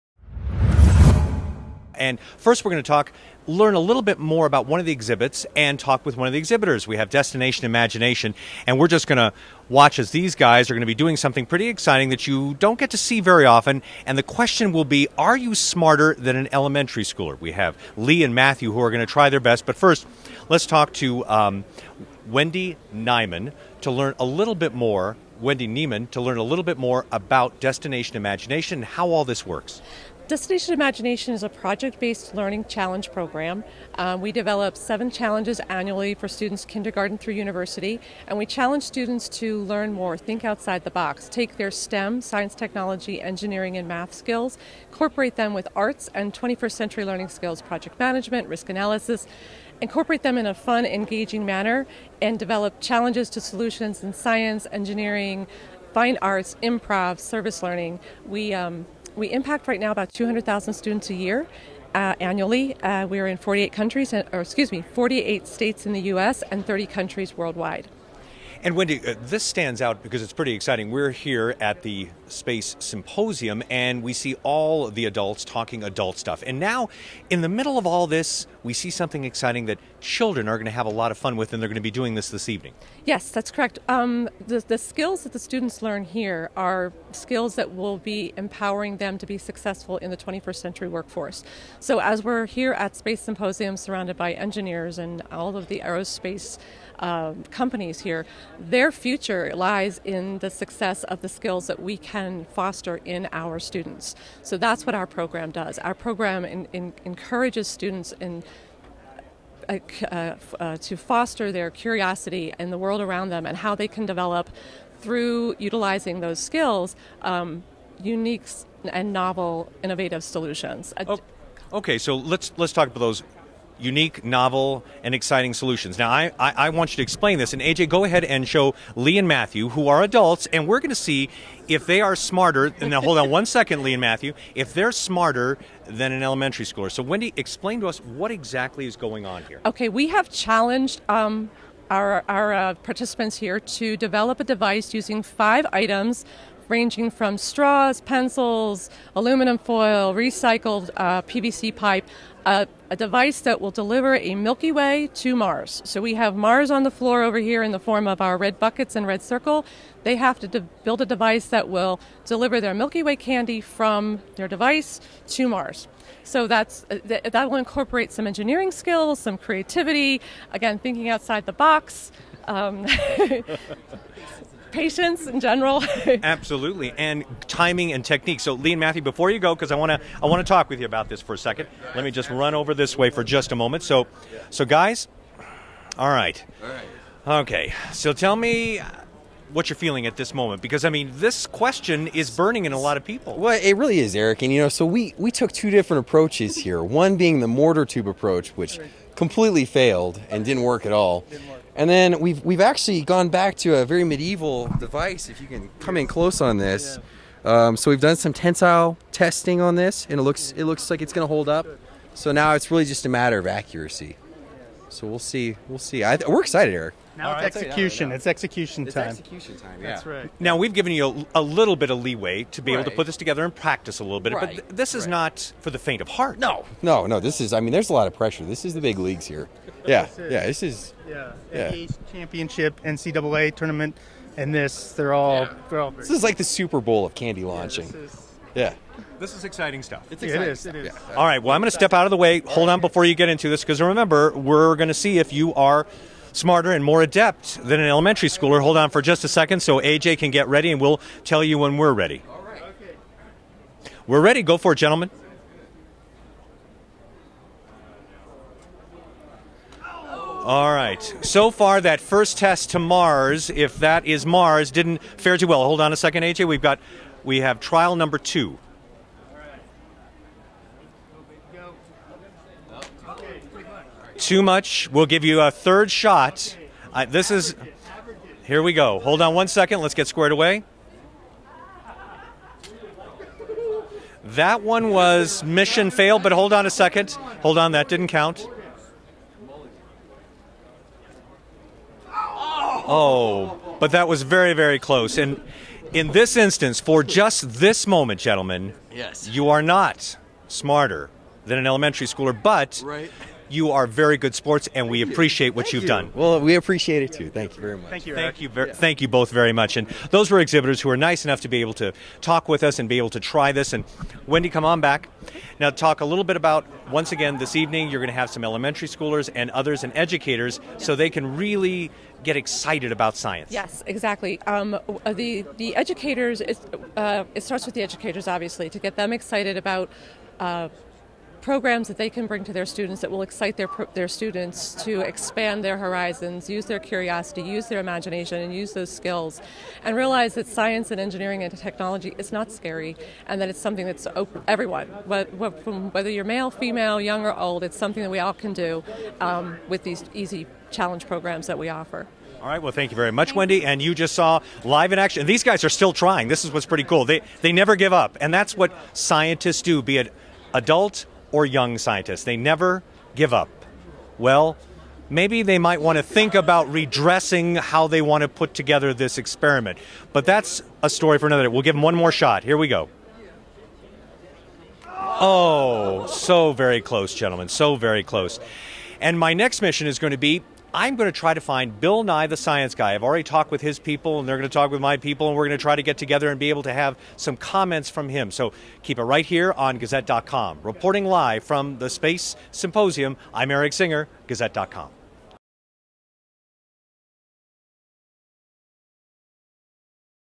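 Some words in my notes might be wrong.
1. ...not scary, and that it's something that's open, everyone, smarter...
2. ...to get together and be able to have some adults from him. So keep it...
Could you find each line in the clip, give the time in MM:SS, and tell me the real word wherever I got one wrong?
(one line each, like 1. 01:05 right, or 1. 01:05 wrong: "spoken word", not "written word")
1. 05:42 wrong: "whether", not "smarter"
2. 06:25 wrong: "comments", not "adults".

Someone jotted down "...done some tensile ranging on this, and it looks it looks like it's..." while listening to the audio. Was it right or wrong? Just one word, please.
wrong.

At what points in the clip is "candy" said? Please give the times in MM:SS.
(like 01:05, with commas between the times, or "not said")
02:43, 03:57.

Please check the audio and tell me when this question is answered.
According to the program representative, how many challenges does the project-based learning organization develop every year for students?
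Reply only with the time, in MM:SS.
00:34.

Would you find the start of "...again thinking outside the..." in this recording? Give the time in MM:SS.
02:50.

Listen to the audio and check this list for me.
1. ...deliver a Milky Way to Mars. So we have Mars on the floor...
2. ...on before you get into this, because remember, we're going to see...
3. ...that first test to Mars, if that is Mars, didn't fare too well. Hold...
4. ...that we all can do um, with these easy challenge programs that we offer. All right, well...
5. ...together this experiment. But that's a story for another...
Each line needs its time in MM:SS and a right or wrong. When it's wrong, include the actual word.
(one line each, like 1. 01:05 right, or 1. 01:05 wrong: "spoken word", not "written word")
1. 02:33 right
2. 04:02 right
3. 04:21 right
4. 05:48 right
5. 06:08 right.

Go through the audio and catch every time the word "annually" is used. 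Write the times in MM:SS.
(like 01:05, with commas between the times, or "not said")
00:35, 01:02.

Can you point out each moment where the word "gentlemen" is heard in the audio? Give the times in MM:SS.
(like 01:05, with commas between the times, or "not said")
04:14, 04:58, 06:17.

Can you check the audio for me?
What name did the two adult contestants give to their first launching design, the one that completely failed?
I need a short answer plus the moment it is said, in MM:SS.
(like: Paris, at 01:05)
mortar tube approach, at 03:17.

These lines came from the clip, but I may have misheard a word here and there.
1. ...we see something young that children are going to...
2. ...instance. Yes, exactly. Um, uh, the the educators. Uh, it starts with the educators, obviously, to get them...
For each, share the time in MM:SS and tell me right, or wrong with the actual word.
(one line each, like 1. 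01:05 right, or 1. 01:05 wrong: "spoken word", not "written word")
1. 01:18 wrong: "exciting", not "young"
2. 05:23 wrong: "science", not "instance".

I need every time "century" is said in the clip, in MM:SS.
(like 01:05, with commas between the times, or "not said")
00:46, 01:30.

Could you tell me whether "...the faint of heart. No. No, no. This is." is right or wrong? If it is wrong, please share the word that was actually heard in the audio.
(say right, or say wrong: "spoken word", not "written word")
right.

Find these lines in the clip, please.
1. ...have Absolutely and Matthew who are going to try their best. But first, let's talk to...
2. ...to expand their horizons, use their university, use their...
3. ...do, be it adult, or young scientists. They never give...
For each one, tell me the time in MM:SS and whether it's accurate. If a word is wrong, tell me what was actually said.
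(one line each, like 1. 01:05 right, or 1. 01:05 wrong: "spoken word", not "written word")
1. 00:17 wrong: "Lee", not "Absolutely"
2. 05:34 wrong: "curiosity", not "university"
3. 05:59 right.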